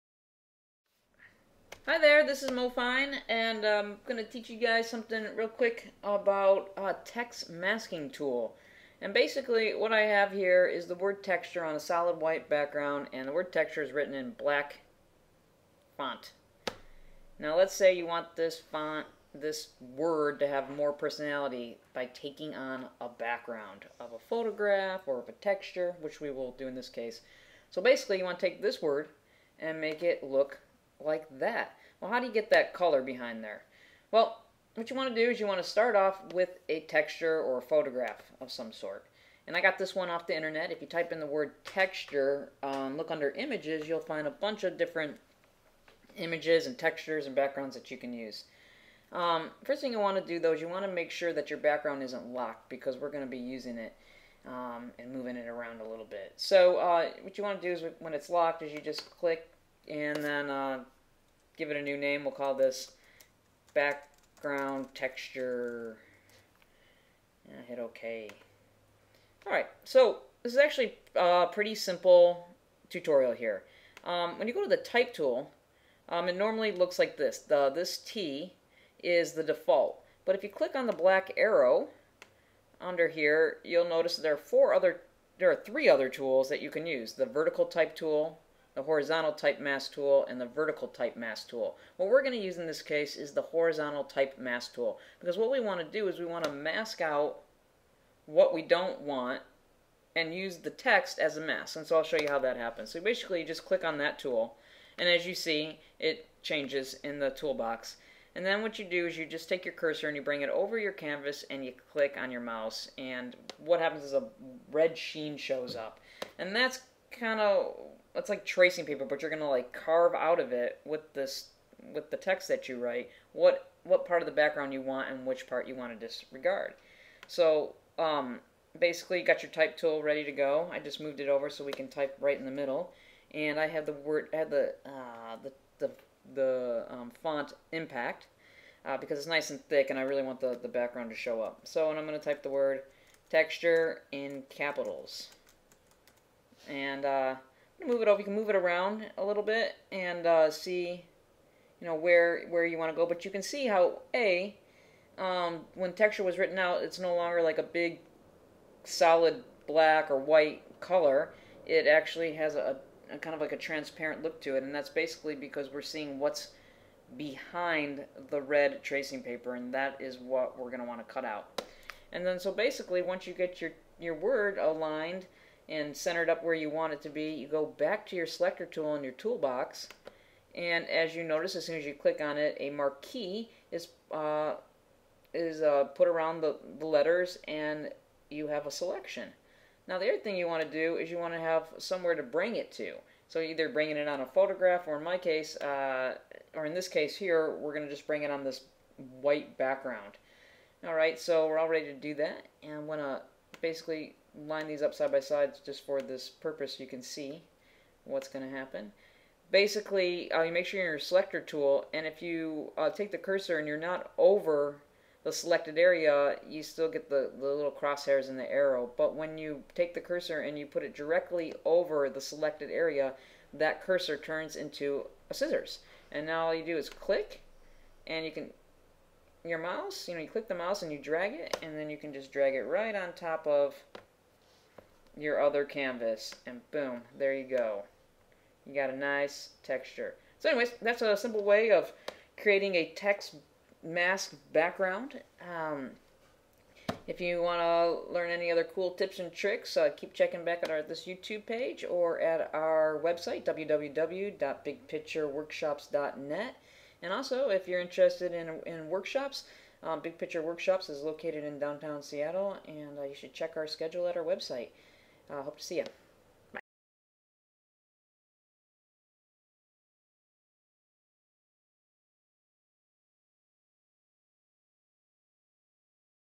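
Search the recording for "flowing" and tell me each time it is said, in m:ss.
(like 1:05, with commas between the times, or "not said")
not said.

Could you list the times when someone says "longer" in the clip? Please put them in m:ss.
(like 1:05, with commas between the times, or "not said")
2:37.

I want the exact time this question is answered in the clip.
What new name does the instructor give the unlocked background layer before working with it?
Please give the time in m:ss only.
1:03.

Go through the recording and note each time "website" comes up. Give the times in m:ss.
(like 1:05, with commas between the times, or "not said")
4:13, 4:24.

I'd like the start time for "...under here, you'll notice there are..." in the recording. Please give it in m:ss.
1:22.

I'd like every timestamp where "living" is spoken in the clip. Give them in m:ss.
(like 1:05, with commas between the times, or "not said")
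not said.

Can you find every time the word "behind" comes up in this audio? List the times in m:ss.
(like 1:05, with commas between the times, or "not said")
0:33, 2:47.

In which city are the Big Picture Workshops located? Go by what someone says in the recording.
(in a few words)
Seattle.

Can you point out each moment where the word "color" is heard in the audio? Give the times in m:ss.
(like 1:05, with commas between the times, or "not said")
0:32, 2:40.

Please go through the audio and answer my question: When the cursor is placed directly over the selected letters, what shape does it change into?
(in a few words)
scissors.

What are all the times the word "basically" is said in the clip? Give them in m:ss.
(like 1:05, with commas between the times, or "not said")
0:09, 0:27, 1:43, 2:08, 2:44, 2:52, 3:23, 3:29.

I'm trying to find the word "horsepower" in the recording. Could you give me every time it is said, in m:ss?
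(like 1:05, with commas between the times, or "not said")
not said.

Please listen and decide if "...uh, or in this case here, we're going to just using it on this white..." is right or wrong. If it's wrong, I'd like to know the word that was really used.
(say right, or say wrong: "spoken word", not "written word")
wrong: "bring", not "using".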